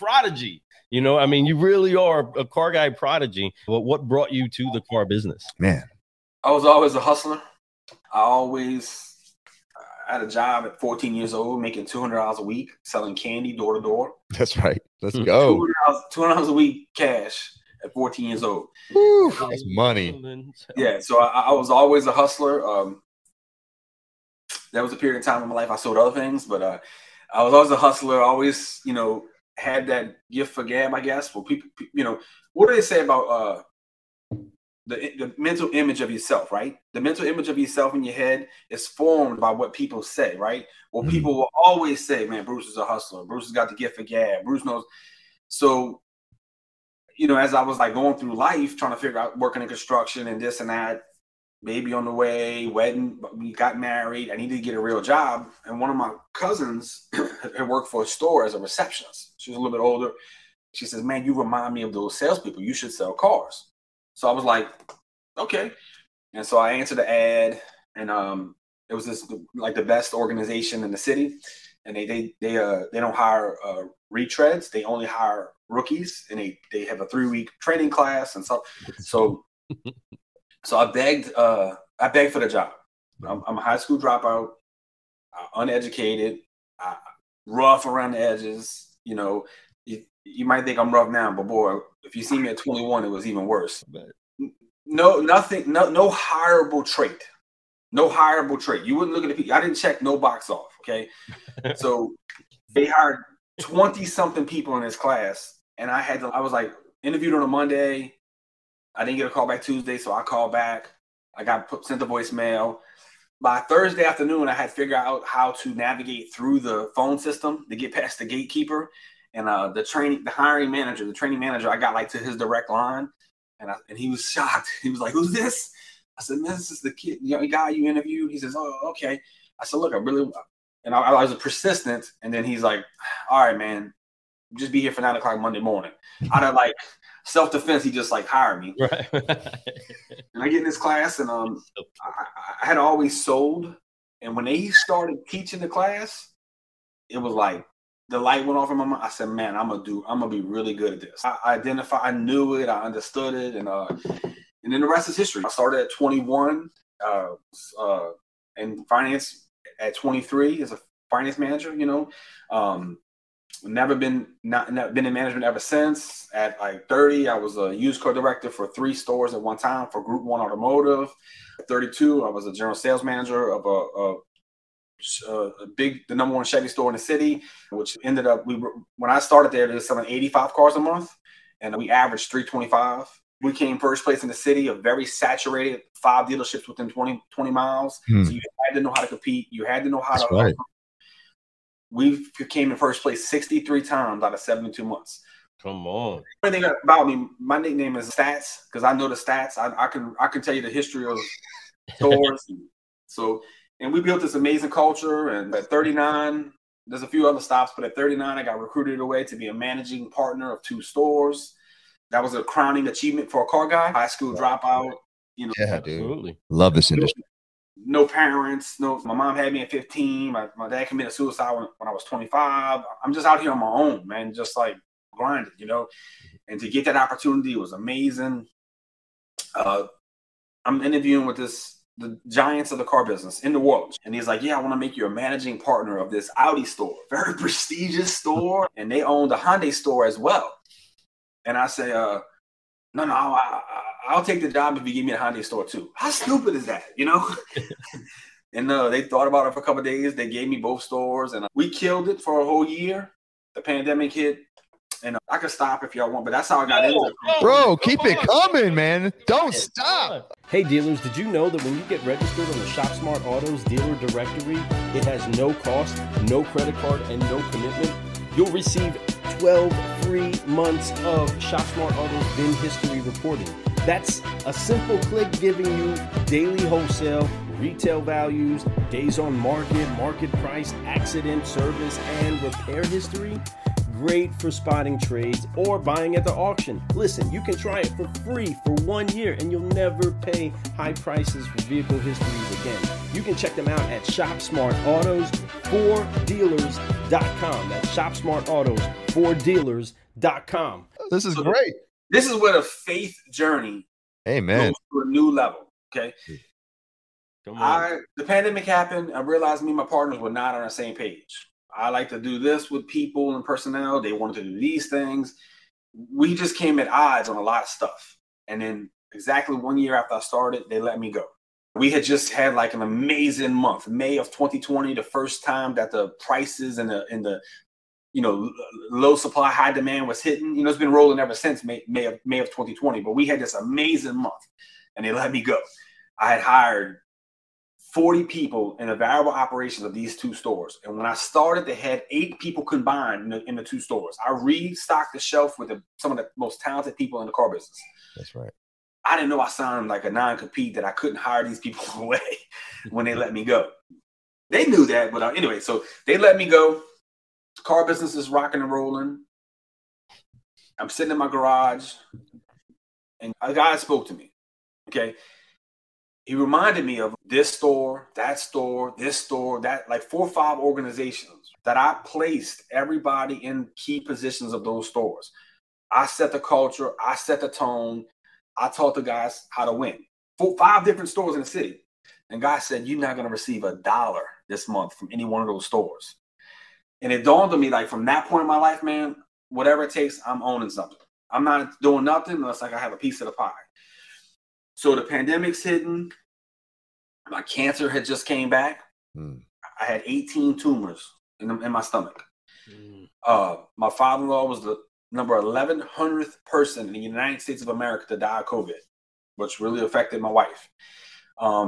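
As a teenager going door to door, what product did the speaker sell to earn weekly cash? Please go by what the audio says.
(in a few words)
candy.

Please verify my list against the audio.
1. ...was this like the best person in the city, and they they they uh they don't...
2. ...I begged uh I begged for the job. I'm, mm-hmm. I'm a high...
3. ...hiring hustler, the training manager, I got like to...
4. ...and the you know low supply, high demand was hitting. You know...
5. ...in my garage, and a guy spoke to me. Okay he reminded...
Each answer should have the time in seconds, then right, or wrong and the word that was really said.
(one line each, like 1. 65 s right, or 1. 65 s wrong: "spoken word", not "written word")
1. 68 s wrong: "organization", not "person"
2. 80 s right
3. 120 s wrong: "manager", not "hustler"
4. 327 s right
5. 361 s right.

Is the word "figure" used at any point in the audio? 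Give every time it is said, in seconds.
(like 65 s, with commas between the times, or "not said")
48 s, 114 s.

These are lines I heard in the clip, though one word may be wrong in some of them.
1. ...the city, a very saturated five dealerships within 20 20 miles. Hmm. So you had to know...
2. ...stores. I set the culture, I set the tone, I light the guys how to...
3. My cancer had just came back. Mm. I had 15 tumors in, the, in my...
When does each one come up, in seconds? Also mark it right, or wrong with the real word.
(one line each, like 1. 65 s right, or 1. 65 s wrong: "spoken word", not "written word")
1. 184 s right
2. 374 s wrong: "taught", not "light"
3. 397 s wrong: "18", not "15".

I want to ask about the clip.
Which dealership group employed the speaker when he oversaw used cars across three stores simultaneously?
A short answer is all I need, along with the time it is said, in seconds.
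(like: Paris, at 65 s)
Group One Automotive, at 170 s.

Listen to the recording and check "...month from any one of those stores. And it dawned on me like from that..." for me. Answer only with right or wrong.
right.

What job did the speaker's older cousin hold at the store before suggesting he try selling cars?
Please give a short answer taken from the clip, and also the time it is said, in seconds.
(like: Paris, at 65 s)
receptionist, at 58 s.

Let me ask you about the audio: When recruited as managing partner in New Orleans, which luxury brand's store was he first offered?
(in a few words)
Audi.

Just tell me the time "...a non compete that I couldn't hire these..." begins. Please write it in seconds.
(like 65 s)
350 s.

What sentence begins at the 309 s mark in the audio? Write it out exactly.
I realized me and my partners were not on the same page.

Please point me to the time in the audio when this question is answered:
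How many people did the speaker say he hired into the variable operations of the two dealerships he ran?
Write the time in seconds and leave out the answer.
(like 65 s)
337 s.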